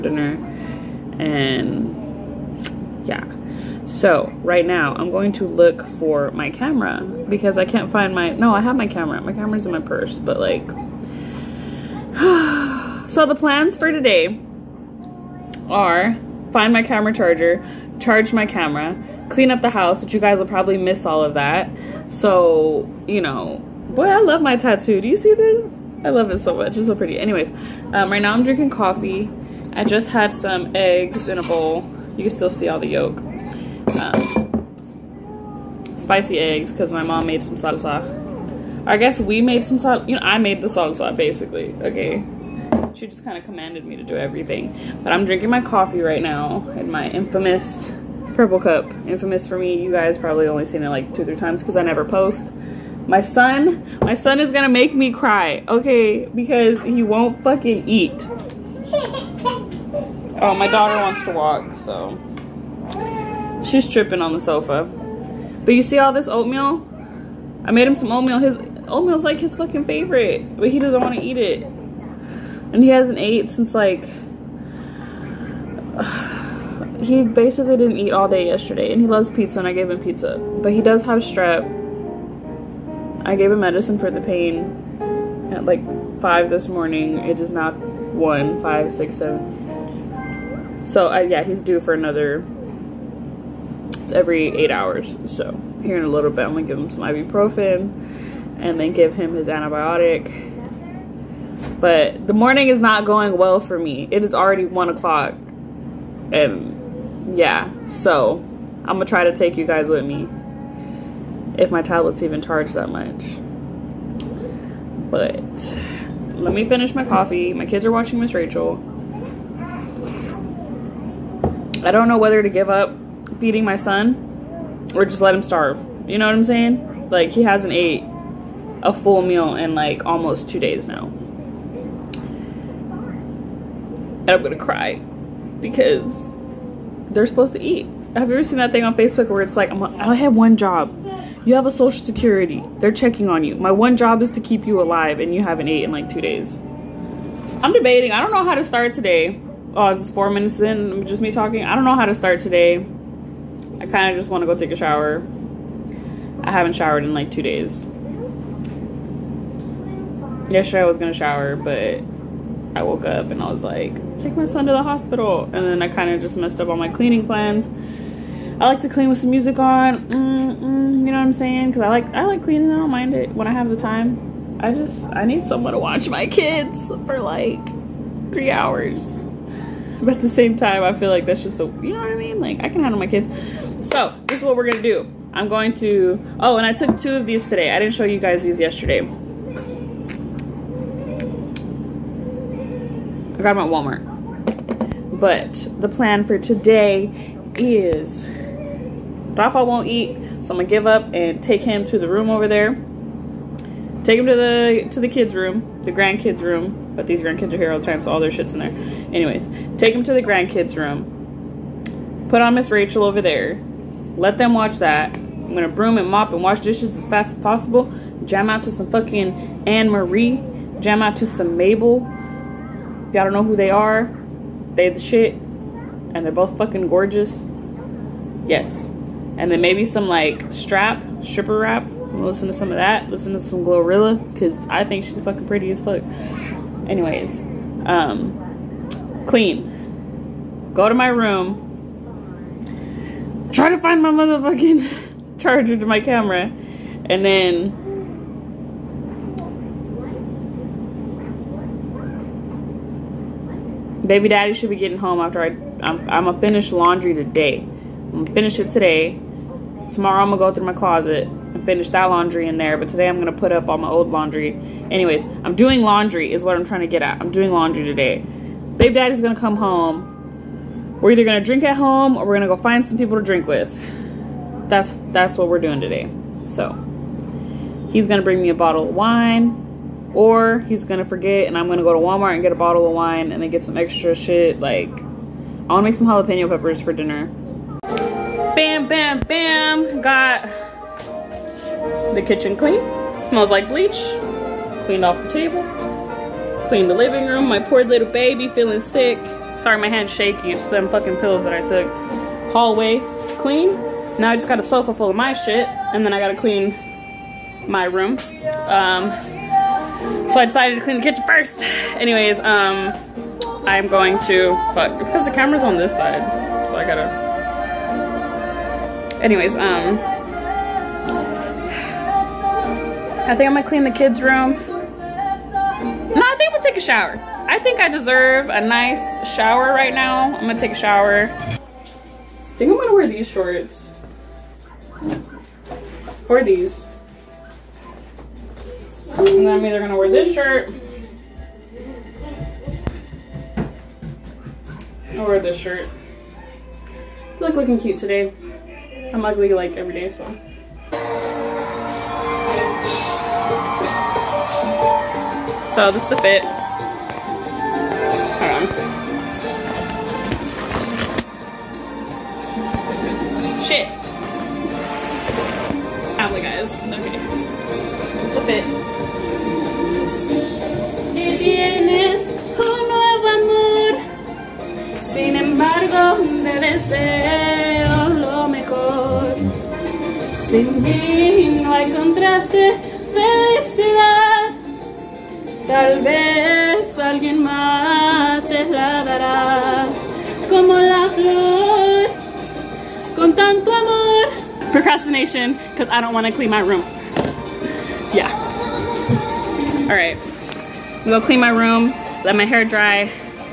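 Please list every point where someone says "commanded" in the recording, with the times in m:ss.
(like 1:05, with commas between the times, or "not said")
0:43.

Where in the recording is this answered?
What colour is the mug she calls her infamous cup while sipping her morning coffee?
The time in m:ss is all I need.
0:48.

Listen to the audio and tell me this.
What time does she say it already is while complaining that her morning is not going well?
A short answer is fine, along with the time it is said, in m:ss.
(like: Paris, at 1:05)
1 o'clock, at 1:44.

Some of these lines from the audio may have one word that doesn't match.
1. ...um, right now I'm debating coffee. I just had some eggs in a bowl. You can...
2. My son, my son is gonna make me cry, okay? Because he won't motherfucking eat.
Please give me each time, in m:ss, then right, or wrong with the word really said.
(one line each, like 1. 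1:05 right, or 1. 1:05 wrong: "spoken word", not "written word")
1. 0:27 wrong: "drinking", not "debating"
2. 0:53 wrong: "fucking", not "motherfucking".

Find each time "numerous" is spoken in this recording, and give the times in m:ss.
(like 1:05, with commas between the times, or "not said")
not said.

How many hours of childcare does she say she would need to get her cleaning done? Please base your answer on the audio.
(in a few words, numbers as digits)
3 hours.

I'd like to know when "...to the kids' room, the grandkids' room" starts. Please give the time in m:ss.
3:24.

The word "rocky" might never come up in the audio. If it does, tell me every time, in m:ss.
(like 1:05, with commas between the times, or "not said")
not said.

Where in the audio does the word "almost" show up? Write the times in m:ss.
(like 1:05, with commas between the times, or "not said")
2:10.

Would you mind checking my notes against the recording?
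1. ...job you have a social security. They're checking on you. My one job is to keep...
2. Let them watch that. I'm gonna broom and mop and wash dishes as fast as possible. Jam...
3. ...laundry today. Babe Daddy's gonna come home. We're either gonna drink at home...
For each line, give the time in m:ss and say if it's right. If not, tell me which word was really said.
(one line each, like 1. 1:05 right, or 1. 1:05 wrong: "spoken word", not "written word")
1. 2:20 right
2. 3:34 right
3. 4:27 right.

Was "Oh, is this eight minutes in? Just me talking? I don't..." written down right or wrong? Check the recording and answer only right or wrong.
wrong.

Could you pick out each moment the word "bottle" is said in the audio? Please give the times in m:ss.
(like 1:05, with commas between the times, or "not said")
4:38, 4:42.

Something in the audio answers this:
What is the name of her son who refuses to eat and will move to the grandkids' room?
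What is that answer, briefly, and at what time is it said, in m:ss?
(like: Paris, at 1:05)
Rafa, at 3:19.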